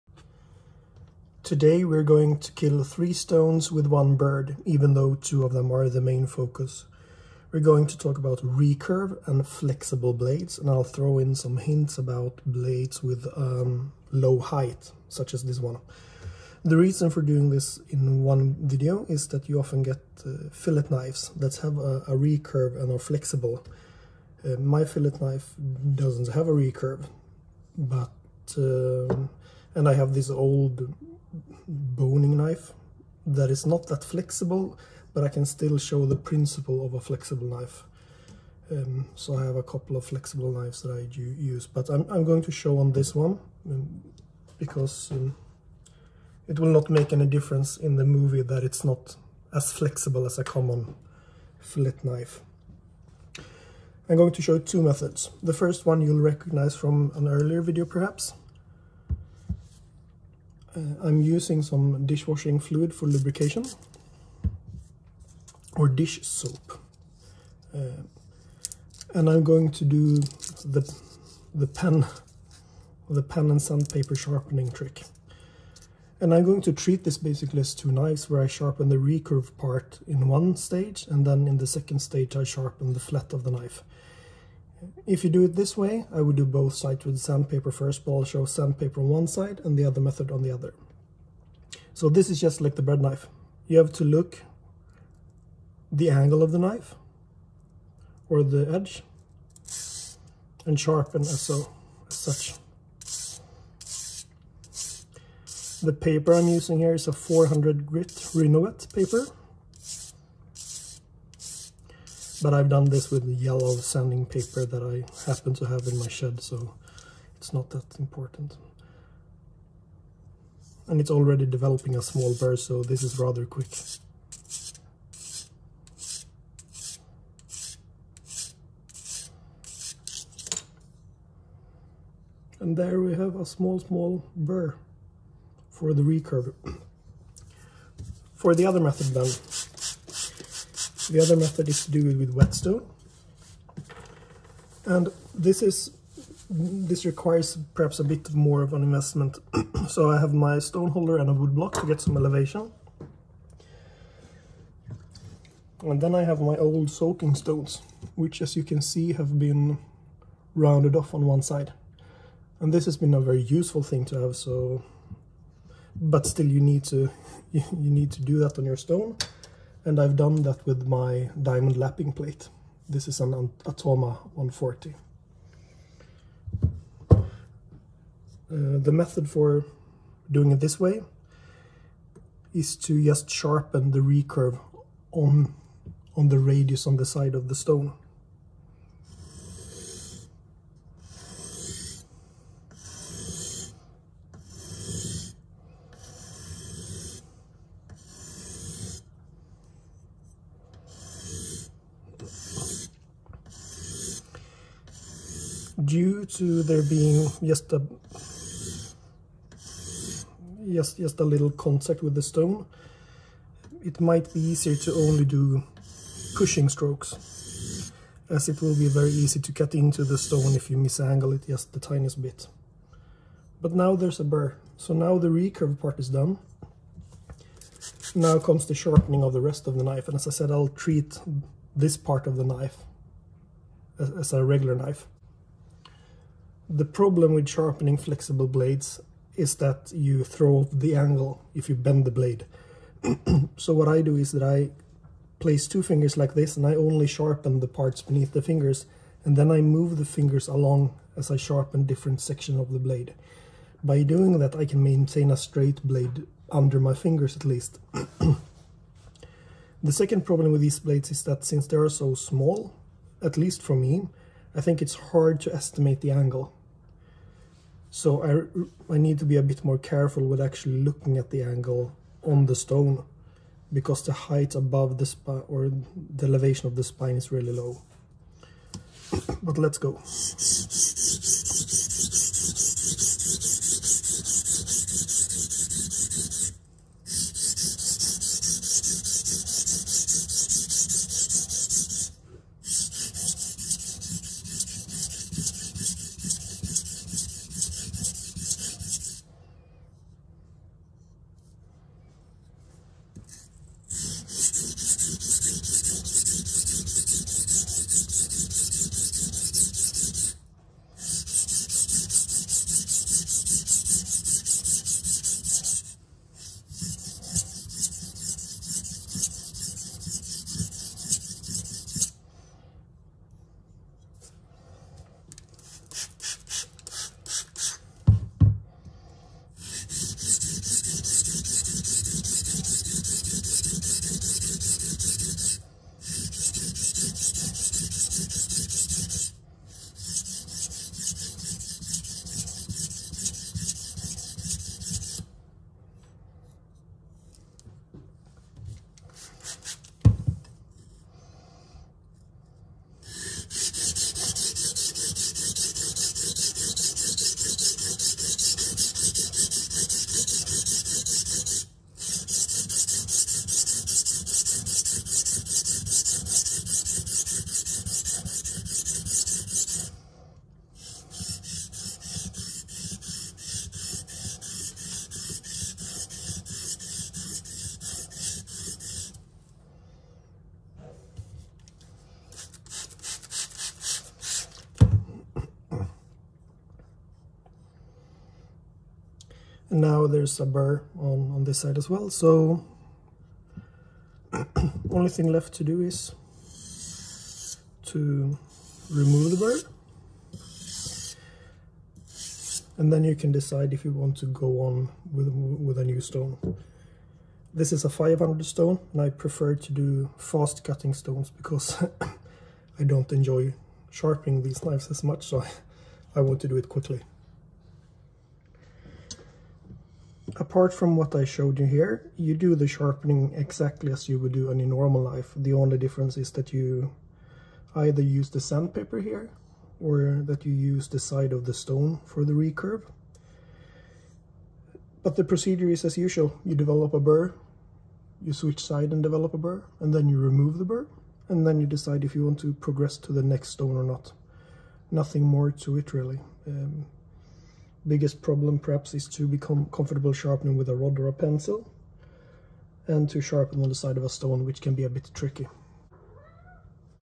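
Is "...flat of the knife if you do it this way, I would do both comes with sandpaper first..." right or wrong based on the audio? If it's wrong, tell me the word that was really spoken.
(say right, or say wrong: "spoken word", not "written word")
wrong: "sides", not "comes".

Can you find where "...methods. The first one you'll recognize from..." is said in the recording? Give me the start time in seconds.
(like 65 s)
54 s.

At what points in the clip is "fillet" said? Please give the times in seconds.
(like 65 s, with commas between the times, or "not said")
20 s, 24 s, 51 s.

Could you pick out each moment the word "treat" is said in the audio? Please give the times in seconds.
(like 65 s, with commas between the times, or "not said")
76 s, 230 s.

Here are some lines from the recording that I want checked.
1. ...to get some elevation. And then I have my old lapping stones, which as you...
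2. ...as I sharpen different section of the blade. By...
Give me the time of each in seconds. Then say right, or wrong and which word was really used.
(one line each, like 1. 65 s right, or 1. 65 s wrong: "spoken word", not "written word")
1. 151 s wrong: "soaking", not "lapping"
2. 251 s right.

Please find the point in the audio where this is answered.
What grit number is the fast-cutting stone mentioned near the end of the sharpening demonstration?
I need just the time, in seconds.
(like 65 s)
407 s.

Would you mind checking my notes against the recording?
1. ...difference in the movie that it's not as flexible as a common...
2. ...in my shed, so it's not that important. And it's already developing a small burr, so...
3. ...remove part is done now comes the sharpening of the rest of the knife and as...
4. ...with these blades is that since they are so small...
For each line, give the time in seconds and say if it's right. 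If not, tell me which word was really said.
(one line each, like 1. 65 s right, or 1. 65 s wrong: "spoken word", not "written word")
1. 47 s right
2. 115 s right
3. 225 s wrong: "recurve", not "remove"
4. 260 s right.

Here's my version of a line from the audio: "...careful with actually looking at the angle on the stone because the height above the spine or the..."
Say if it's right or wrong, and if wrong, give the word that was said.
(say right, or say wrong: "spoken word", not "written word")
right.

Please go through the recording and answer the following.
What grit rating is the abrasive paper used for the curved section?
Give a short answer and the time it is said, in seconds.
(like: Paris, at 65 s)
400, at 107 s.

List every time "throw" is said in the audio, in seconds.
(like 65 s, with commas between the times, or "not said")
10 s, 240 s.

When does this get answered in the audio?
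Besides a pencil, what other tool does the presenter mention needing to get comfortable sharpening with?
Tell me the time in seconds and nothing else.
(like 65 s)
450 s.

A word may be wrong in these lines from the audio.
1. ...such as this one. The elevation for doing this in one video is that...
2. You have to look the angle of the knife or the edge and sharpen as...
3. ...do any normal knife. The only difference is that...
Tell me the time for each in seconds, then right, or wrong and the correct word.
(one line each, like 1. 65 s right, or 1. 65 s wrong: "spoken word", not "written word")
1. 15 s wrong: "reason", not "elevation"
2. 93 s right
3. 424 s right.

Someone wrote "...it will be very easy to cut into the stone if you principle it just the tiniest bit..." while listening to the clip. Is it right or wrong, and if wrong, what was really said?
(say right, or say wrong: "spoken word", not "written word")
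wrong: "misangle", not "principle".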